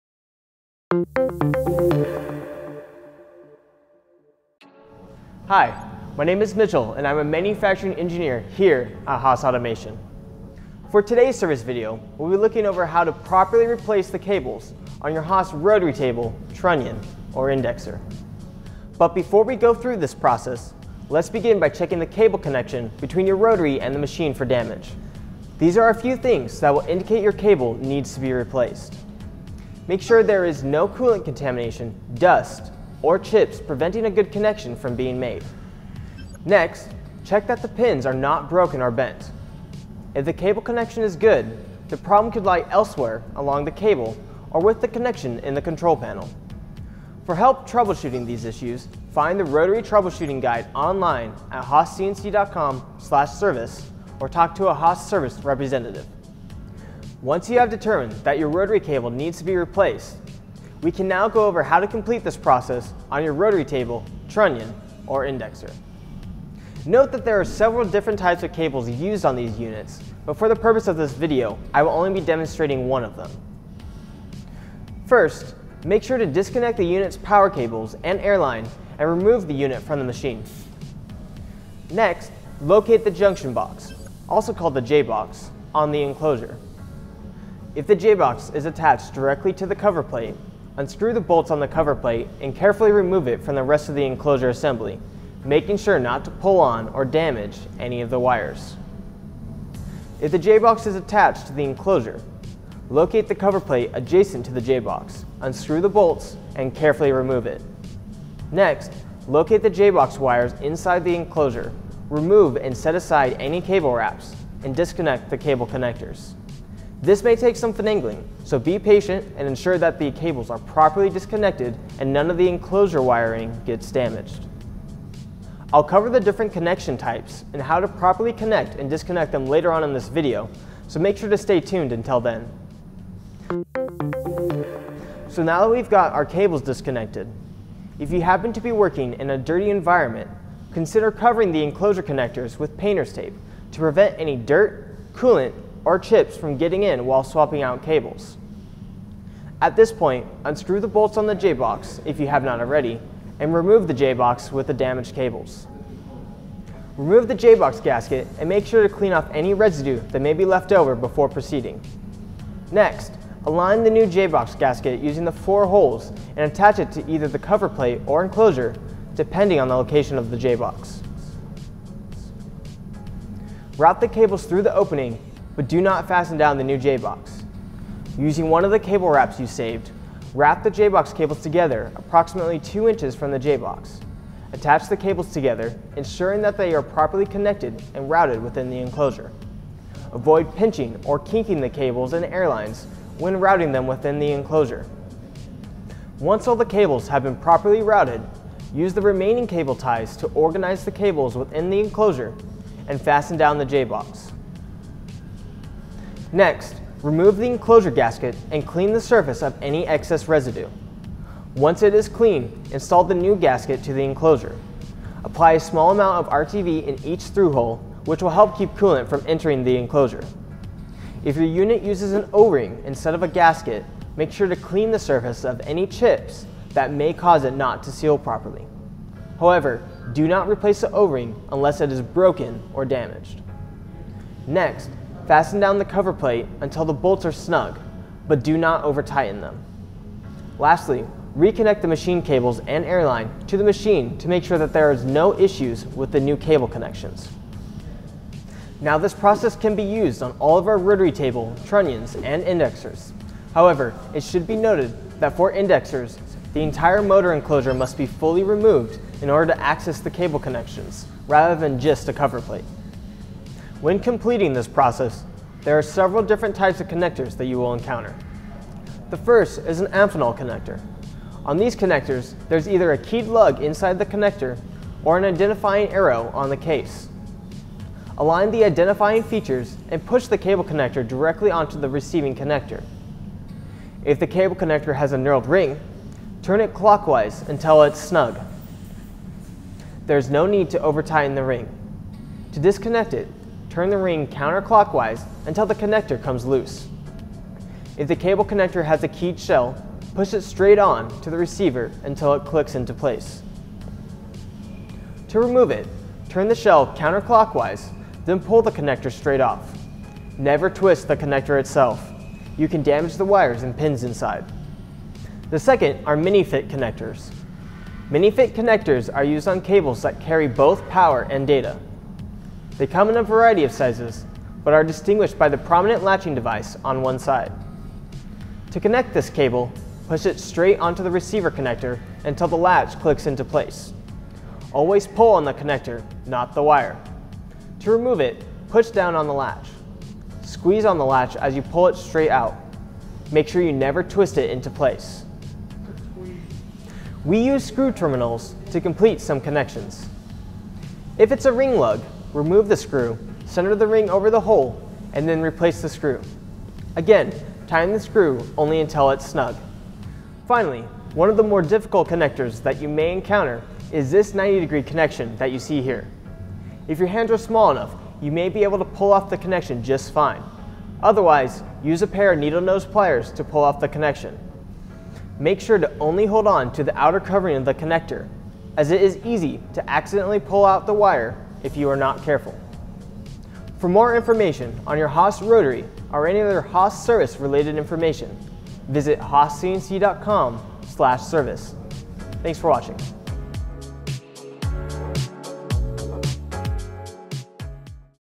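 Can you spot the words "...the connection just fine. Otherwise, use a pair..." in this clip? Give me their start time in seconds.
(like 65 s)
369 s.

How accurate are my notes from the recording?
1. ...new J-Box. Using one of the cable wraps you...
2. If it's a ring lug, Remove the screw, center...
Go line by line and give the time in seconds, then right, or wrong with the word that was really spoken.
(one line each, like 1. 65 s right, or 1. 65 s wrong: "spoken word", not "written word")
1. 176 s right
2. 351 s right.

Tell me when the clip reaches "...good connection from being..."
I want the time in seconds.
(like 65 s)
34 s.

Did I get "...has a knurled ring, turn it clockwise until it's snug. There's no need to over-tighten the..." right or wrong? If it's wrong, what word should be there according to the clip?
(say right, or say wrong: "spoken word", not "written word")
right.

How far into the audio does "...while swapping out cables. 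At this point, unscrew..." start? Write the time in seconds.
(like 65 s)
147 s.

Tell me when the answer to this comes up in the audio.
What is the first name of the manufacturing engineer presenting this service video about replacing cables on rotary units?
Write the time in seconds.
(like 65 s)
6 s.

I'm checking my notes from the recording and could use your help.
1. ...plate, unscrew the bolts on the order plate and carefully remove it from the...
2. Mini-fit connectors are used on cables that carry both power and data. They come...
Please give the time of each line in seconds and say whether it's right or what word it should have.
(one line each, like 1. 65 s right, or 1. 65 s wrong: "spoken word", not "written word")
1. 90 s wrong: "cover", not "order"
2. 318 s right.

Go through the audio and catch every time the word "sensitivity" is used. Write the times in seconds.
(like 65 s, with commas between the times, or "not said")
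not said.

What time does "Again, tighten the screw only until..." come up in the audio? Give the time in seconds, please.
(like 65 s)
356 s.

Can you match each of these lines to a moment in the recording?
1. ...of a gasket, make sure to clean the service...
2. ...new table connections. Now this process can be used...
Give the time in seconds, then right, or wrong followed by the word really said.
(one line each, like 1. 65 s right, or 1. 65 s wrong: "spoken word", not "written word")
1. 223 s wrong: "surface", not "service"
2. 246 s wrong: "cable", not "table".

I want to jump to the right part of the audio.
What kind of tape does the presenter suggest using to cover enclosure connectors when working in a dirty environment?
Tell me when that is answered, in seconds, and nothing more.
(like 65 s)
142 s.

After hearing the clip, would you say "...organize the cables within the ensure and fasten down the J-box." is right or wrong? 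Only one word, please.
wrong.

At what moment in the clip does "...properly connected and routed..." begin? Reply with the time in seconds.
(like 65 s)
186 s.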